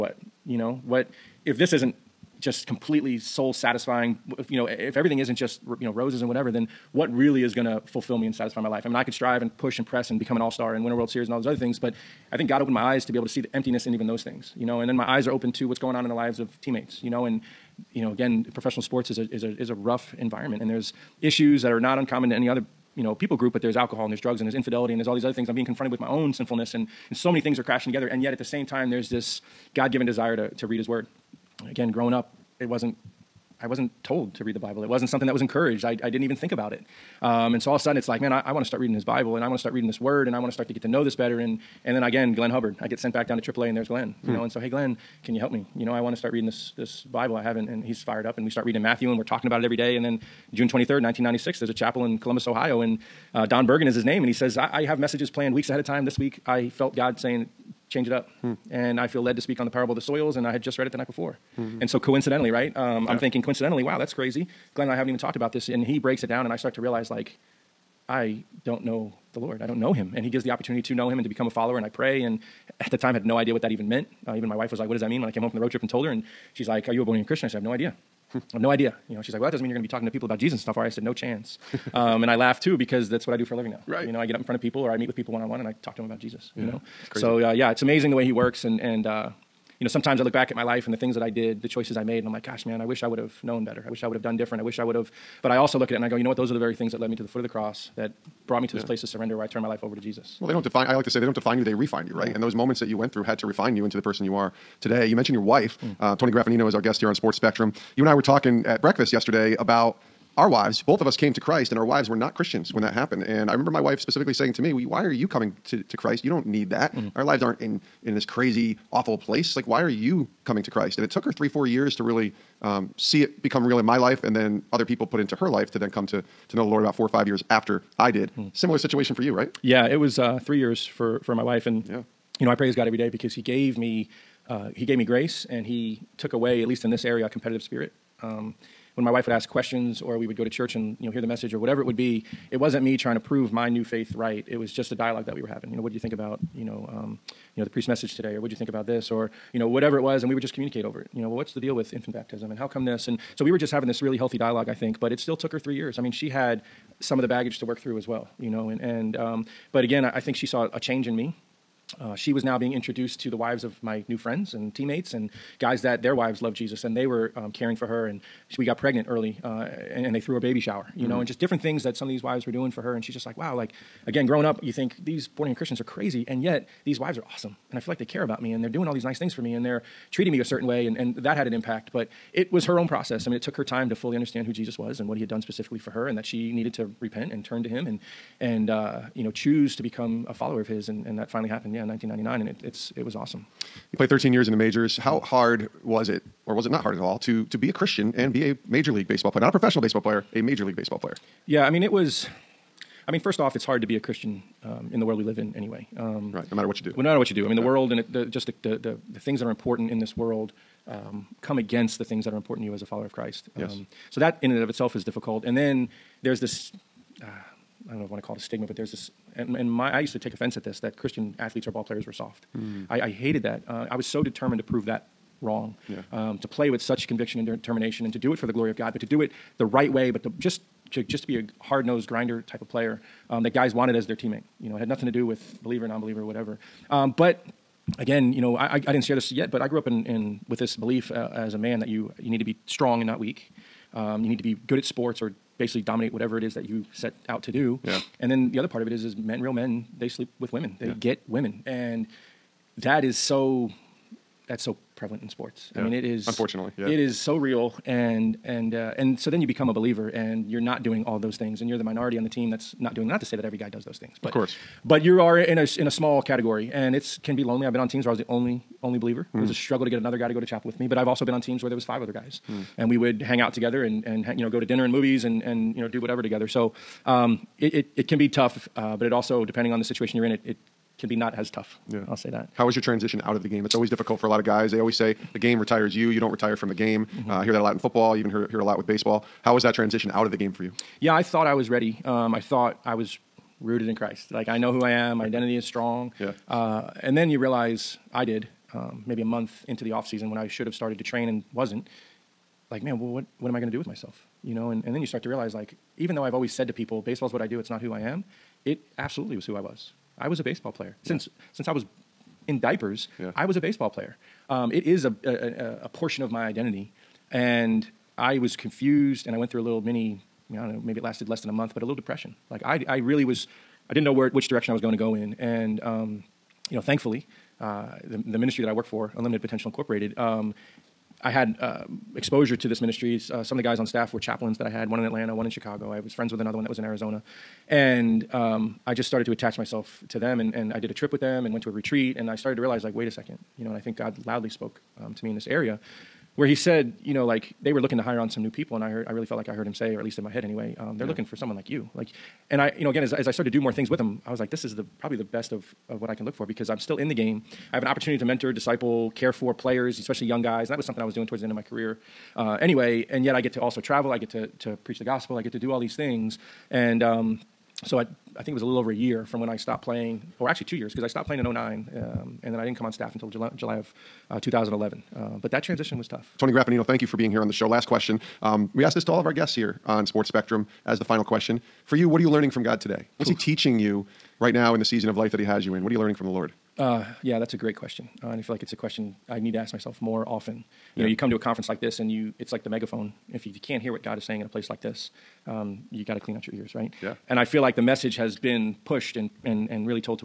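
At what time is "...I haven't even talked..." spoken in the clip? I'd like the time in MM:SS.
01:04.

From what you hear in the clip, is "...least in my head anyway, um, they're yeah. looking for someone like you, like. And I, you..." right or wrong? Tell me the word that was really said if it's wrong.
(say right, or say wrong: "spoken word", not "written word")
right.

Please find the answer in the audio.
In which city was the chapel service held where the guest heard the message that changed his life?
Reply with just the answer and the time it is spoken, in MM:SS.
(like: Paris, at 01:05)
Columbus, Ohio, at 00:52.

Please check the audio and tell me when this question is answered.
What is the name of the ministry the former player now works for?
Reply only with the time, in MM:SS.
05:29.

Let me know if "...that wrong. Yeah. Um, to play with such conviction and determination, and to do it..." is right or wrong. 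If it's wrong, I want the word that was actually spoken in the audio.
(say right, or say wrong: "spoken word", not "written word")
right.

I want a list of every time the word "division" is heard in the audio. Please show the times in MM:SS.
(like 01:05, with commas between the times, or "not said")
not said.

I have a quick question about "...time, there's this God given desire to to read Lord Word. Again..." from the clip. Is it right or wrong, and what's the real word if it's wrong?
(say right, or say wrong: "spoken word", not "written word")
wrong: "His", not "Lord".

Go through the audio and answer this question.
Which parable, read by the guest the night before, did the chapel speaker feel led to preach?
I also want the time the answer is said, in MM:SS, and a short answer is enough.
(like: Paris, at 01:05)
Parable of the soils, at 00:59.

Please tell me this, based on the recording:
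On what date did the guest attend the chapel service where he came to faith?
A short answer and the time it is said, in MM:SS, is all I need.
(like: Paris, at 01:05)
June 23, 1996, at 00:50.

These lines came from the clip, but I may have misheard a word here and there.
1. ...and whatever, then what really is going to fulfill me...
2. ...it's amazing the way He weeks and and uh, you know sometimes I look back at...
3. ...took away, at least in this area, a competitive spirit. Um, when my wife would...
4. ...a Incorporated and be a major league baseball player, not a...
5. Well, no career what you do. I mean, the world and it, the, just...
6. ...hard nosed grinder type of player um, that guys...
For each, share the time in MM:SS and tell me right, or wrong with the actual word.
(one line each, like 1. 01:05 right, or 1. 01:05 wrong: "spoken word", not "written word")
1. 00:06 right
2. 01:27 wrong: "works", not "weeks"
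3. 02:16 right
4. 03:17 wrong: "Christian", not "Incorporated"
5. 03:26 wrong: "matter", not "career"
6. 03:51 right.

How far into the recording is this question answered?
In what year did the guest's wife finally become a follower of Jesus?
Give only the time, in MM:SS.
03:11.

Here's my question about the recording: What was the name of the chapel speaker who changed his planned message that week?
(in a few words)
Don Bergen.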